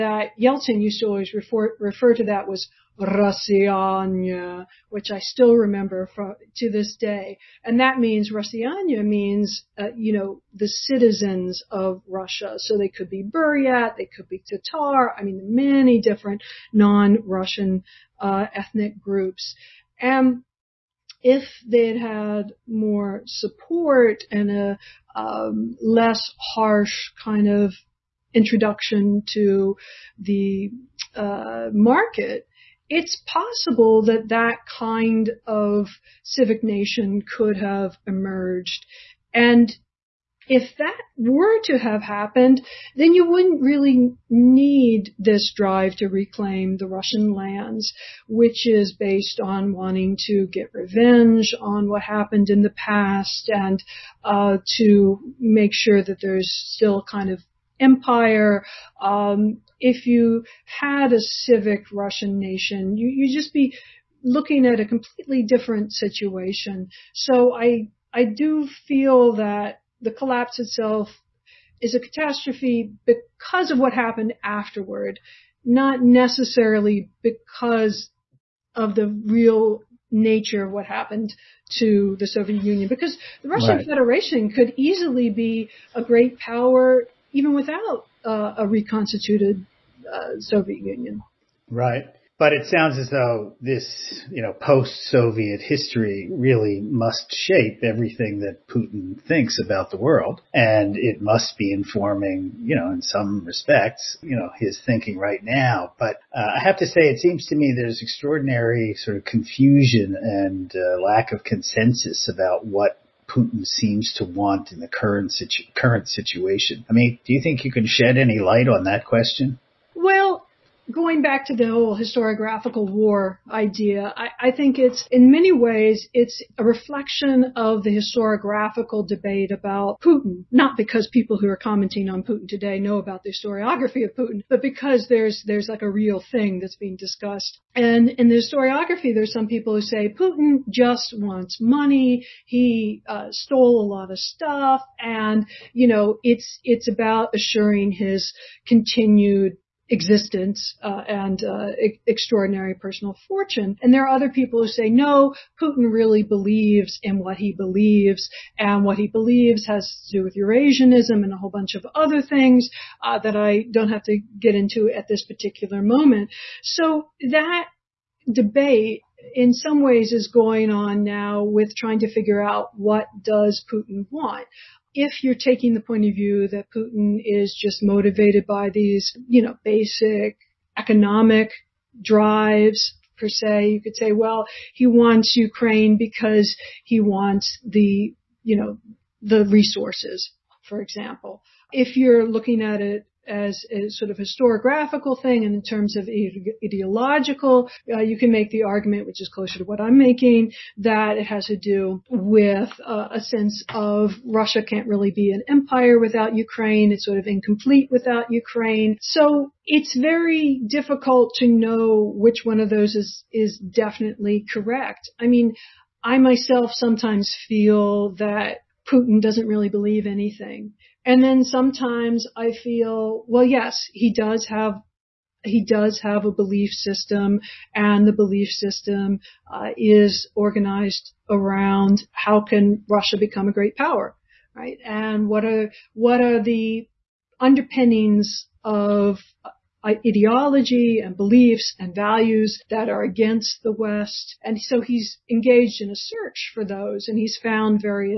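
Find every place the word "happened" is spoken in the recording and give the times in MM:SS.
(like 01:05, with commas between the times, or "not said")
00:42, 00:52, 01:13, 01:20.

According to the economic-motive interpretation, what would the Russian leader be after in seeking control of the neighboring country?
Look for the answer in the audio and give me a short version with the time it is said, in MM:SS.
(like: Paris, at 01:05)
the resources, at 03:09.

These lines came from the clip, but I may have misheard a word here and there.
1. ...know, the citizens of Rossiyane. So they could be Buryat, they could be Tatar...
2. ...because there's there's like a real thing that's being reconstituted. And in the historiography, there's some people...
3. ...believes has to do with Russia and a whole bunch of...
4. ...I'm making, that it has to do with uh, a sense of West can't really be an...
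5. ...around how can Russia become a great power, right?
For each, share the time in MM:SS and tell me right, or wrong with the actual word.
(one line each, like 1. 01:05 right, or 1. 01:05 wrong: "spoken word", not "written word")
1. 00:10 wrong: "Russia", not "Rossiyane"
2. 02:14 wrong: "discussed", not "reconstituted"
3. 02:39 wrong: "Eurasianism", not "Russia"
4. 03:19 wrong: "Russia", not "West"
5. 03:51 right.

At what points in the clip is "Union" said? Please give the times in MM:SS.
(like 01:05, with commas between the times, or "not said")
01:22, 01:30.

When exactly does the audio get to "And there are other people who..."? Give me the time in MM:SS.
02:33.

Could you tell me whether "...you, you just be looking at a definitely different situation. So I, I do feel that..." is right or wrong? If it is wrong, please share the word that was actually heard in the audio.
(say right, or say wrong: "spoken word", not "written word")
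wrong: "completely", not "definitely".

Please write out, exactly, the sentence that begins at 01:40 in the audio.
And it must be informing, you know, in some respects, you know, his thinking right now.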